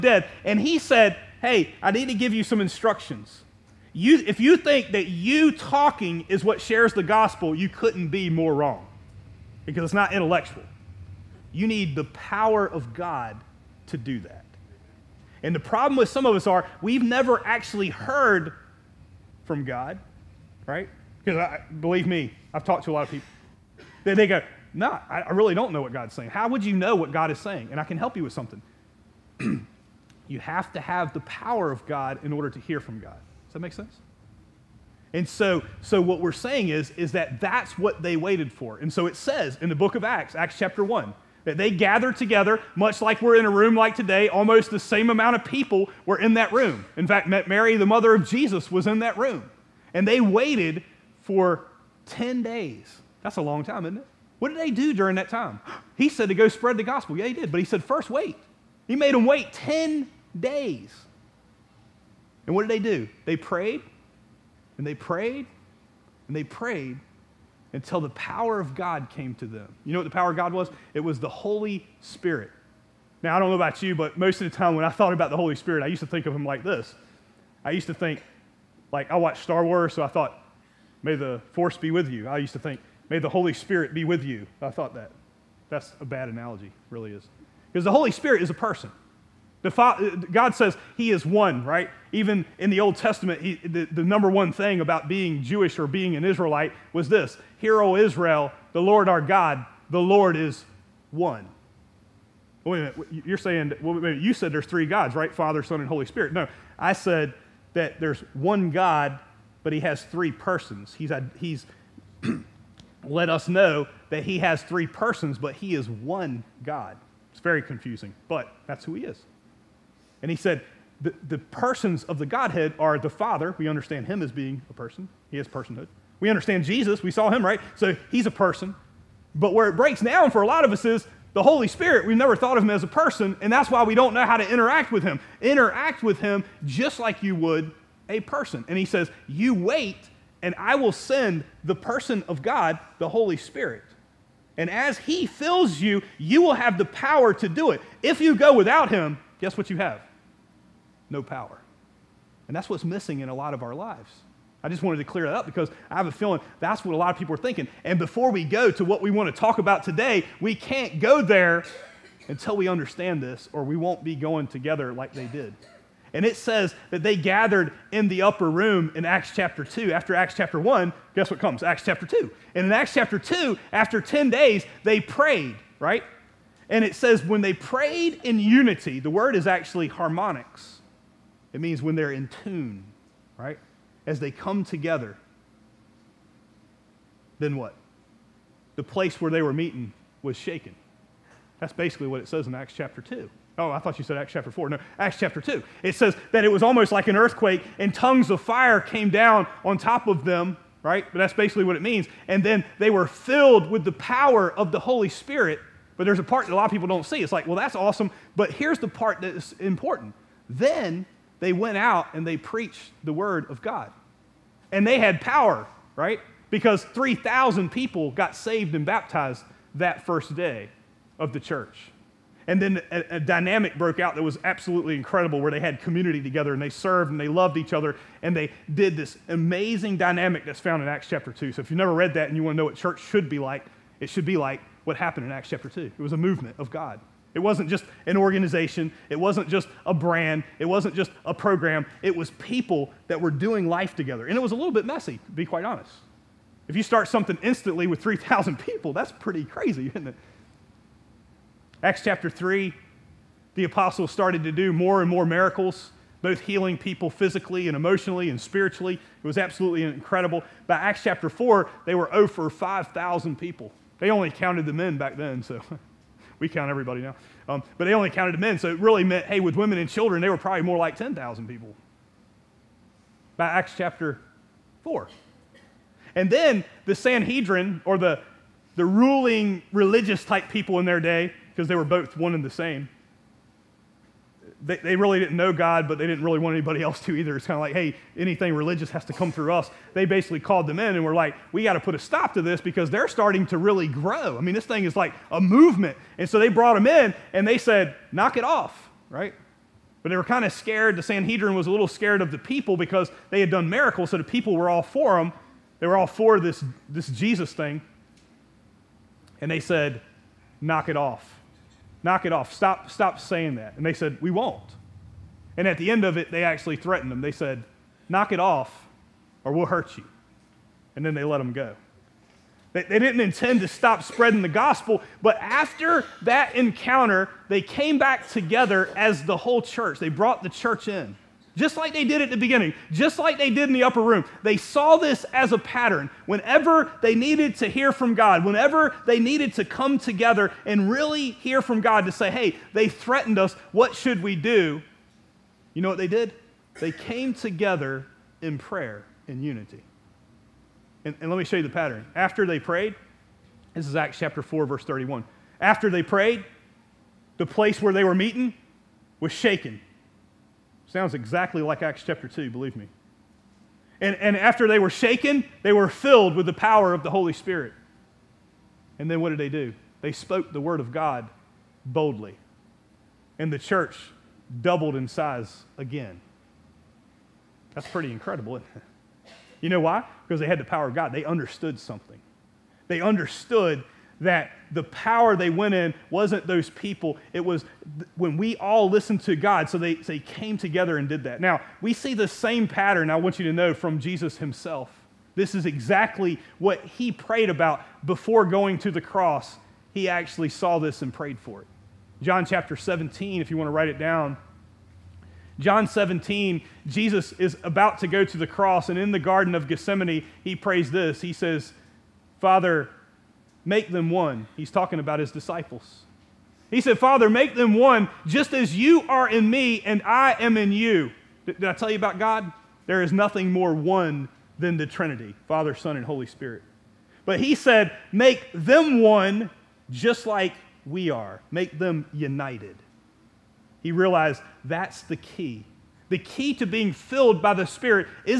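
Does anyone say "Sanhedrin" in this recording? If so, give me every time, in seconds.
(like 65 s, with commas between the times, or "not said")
276 s, 301 s.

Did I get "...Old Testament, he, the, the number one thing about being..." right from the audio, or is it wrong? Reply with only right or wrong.
right.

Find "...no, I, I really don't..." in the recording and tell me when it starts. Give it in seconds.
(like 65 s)
24 s.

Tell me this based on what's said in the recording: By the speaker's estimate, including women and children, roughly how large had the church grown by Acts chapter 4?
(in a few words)
10,000.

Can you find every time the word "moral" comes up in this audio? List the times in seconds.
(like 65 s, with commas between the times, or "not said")
not said.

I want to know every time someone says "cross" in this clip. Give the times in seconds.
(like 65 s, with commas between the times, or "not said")
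399 s, 408 s.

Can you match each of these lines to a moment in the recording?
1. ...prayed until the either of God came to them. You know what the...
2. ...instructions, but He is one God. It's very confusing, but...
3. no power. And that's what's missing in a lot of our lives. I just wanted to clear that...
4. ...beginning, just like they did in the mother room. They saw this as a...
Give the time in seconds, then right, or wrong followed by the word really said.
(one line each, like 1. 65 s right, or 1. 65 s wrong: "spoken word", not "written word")
1. 66 s wrong: "power", not "either"
2. 114 s wrong: "persons", not "instructions"
3. 151 s right
4. 332 s wrong: "upper", not "mother".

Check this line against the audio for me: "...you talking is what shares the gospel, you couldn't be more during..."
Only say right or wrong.
wrong.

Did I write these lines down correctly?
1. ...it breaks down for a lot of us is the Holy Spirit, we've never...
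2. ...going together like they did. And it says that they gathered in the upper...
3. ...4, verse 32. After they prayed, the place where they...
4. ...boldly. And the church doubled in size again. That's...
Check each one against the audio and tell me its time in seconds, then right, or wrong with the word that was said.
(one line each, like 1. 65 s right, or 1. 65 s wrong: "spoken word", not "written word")
1. 129 s right
2. 164 s right
3. 354 s wrong: "31", not "32"
4. 371 s right.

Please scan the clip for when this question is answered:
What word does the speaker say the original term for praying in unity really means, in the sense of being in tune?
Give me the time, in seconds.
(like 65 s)
179 s.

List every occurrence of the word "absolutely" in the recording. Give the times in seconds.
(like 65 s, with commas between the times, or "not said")
224 s, 259 s.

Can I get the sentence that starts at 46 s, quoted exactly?
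In fact, Mary, the mother of Jesus, was in that room.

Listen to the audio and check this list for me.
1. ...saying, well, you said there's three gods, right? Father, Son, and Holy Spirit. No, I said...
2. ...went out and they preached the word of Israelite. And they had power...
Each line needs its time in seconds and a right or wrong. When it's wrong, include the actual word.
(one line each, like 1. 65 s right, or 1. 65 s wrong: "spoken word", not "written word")
1. 103 s right
2. 211 s wrong: "God", not "Israelite".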